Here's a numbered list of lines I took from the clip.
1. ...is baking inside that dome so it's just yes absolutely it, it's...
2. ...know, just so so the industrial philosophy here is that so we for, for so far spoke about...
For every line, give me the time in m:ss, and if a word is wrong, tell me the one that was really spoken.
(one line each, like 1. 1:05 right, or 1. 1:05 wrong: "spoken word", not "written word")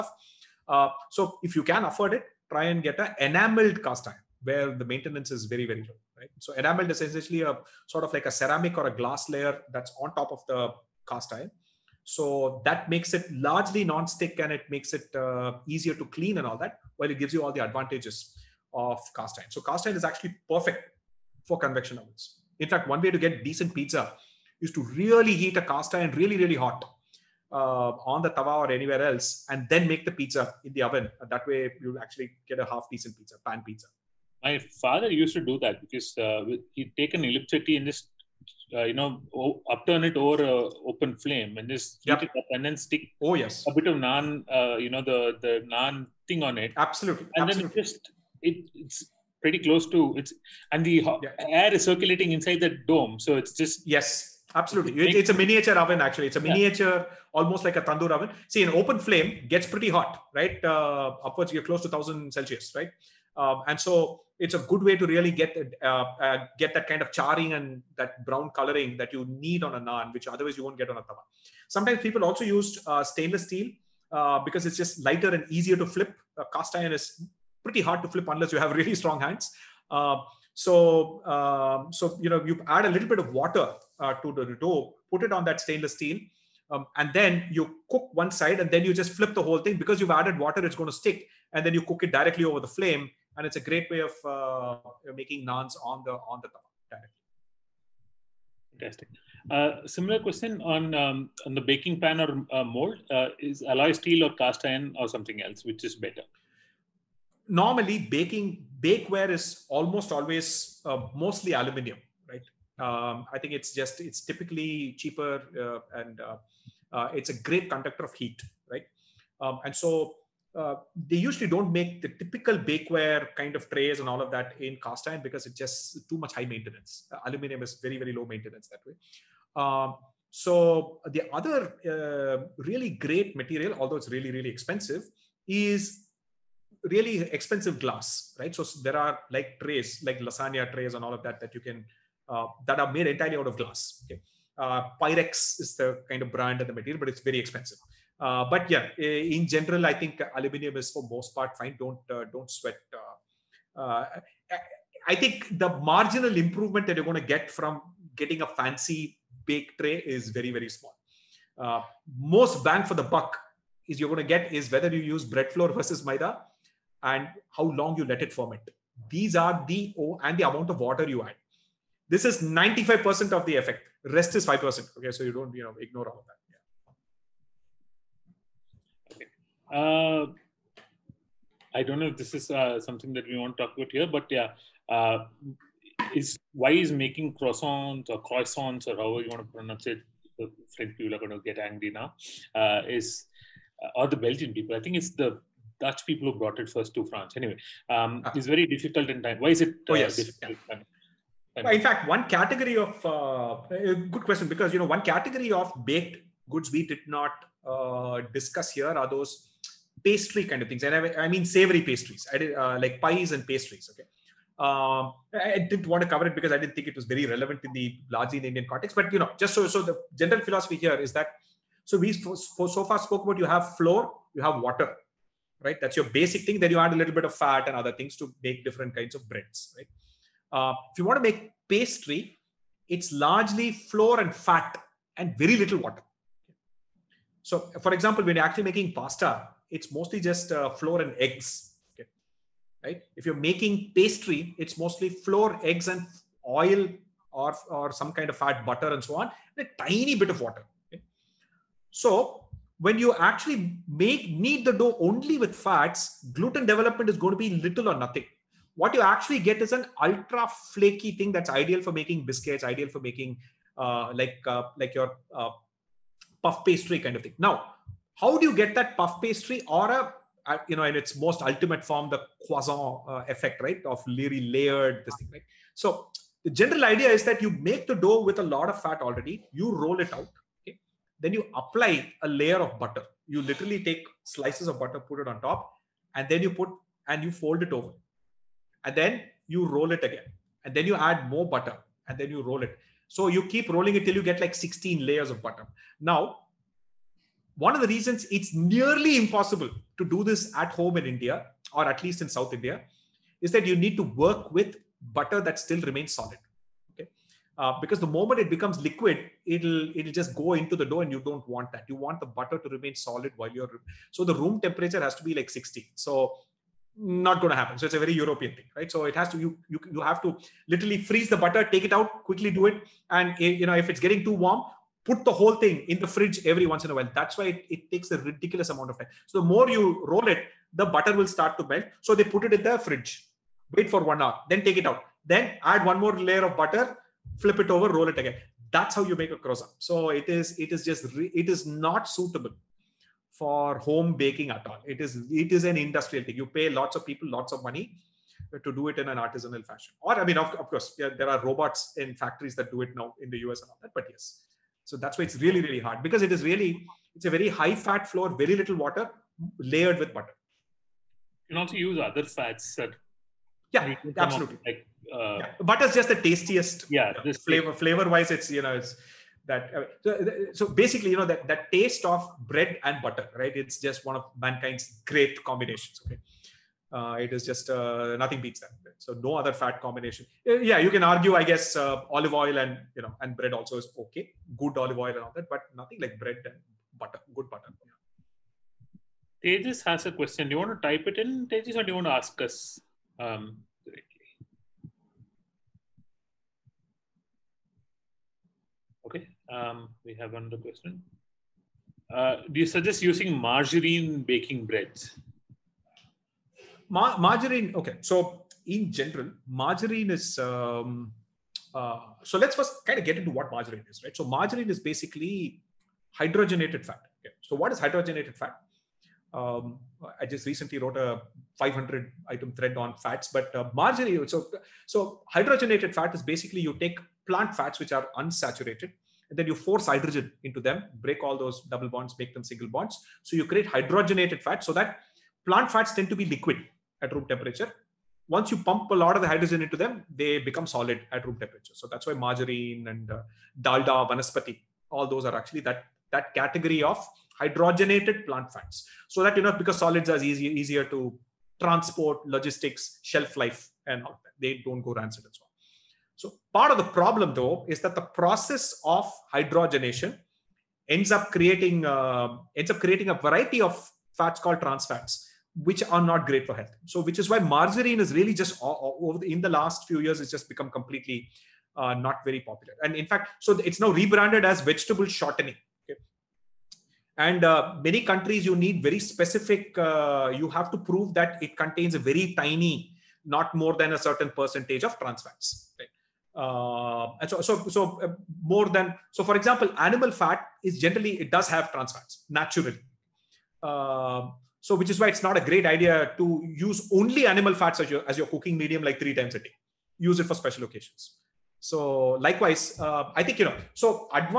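1. 0:51 wrong: "circulating", not "baking"
2. 3:39 wrong: "general", not "industrial".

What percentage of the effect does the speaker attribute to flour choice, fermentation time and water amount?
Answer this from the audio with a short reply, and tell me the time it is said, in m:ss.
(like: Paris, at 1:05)
95%, at 2:52.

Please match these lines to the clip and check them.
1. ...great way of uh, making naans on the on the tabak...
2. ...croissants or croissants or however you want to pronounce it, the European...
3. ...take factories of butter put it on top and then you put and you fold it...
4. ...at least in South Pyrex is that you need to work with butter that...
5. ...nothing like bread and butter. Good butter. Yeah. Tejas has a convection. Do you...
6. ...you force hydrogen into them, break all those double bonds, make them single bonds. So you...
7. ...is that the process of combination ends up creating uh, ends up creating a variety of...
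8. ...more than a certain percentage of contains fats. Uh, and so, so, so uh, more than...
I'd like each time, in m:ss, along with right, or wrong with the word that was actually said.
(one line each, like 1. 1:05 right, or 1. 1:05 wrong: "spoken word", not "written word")
1. 1:33 right
2. 3:07 wrong: "French", not "European"
3. 4:43 wrong: "slices", not "factories"
4. 5:01 wrong: "India", not "Pyrex"
5. 6:25 wrong: "question", not "convection"
6. 7:09 right
7. 7:37 wrong: "hydrogenation", not "combination"
8. 8:03 wrong: "trans", not "contains".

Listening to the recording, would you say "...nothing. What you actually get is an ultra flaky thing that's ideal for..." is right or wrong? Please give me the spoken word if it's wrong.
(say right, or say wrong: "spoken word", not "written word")
right.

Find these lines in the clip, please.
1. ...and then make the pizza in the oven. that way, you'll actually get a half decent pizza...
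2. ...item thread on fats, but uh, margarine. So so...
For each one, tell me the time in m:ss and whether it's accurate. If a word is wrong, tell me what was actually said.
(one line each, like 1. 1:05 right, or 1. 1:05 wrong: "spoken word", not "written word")
1. 0:29 right
2. 7:02 right.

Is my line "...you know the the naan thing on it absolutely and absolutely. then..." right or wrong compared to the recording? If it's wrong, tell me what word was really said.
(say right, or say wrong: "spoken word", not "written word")
right.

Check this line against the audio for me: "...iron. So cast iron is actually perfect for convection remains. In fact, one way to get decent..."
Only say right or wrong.
wrong.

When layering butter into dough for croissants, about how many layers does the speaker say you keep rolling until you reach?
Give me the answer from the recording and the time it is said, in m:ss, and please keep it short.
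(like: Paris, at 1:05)
16, at 4:54.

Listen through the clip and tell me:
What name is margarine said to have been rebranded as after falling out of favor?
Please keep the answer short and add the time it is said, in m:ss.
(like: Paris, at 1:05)
Vegetable shortening, at 7:54.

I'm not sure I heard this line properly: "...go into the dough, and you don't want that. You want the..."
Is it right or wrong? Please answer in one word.
right.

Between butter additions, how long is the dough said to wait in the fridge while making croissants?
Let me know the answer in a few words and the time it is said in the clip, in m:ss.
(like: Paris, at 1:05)
One hour, at 5:34.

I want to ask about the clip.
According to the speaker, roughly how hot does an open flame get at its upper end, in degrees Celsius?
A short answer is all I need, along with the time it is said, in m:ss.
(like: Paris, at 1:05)
1000, at 1:01.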